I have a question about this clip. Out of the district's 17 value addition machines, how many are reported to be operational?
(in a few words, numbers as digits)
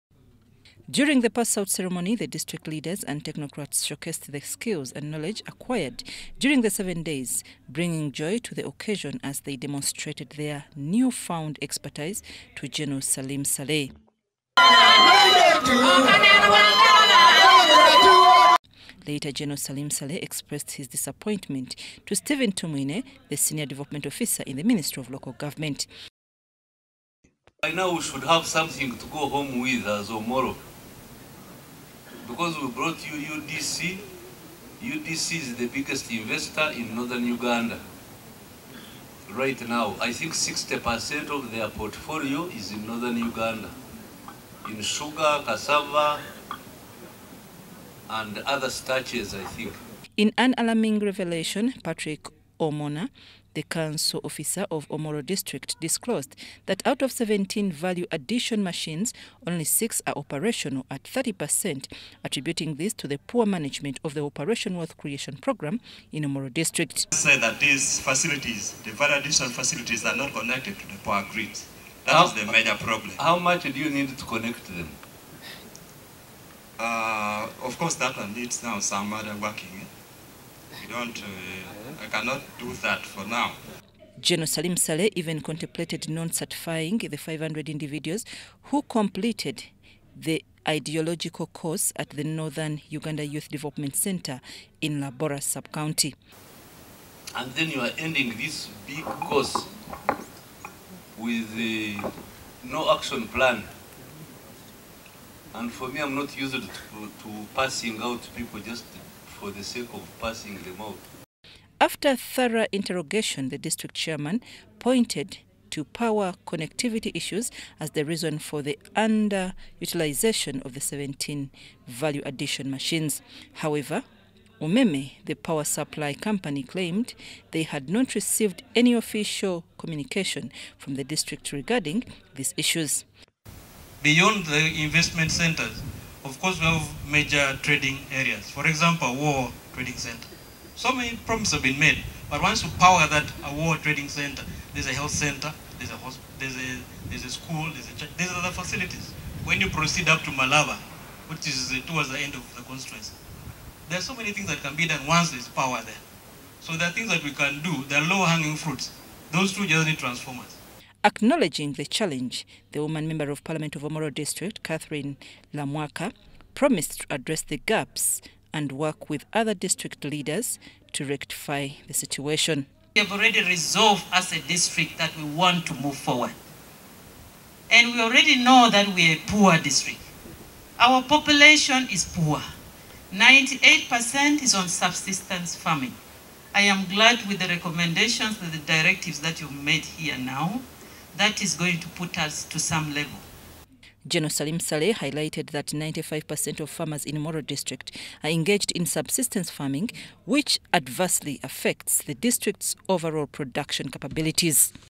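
6.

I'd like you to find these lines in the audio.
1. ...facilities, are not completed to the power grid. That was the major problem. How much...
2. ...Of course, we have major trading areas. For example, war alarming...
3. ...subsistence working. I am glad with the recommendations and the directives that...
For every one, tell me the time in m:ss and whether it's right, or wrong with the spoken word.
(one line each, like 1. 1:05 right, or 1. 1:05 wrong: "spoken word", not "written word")
1. 1:09 wrong: "connected", not "completed"
2. 2:16 wrong: "trading", not "alarming"
3. 3:04 wrong: "farming", not "working".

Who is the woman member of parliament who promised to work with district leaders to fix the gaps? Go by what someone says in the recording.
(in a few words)
Catherine Lamwaka.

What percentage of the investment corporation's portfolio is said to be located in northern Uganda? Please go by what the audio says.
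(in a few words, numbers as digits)
60%.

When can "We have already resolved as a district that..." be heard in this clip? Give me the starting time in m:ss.
2:52.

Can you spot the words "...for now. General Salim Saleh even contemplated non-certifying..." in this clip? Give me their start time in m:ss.
1:22.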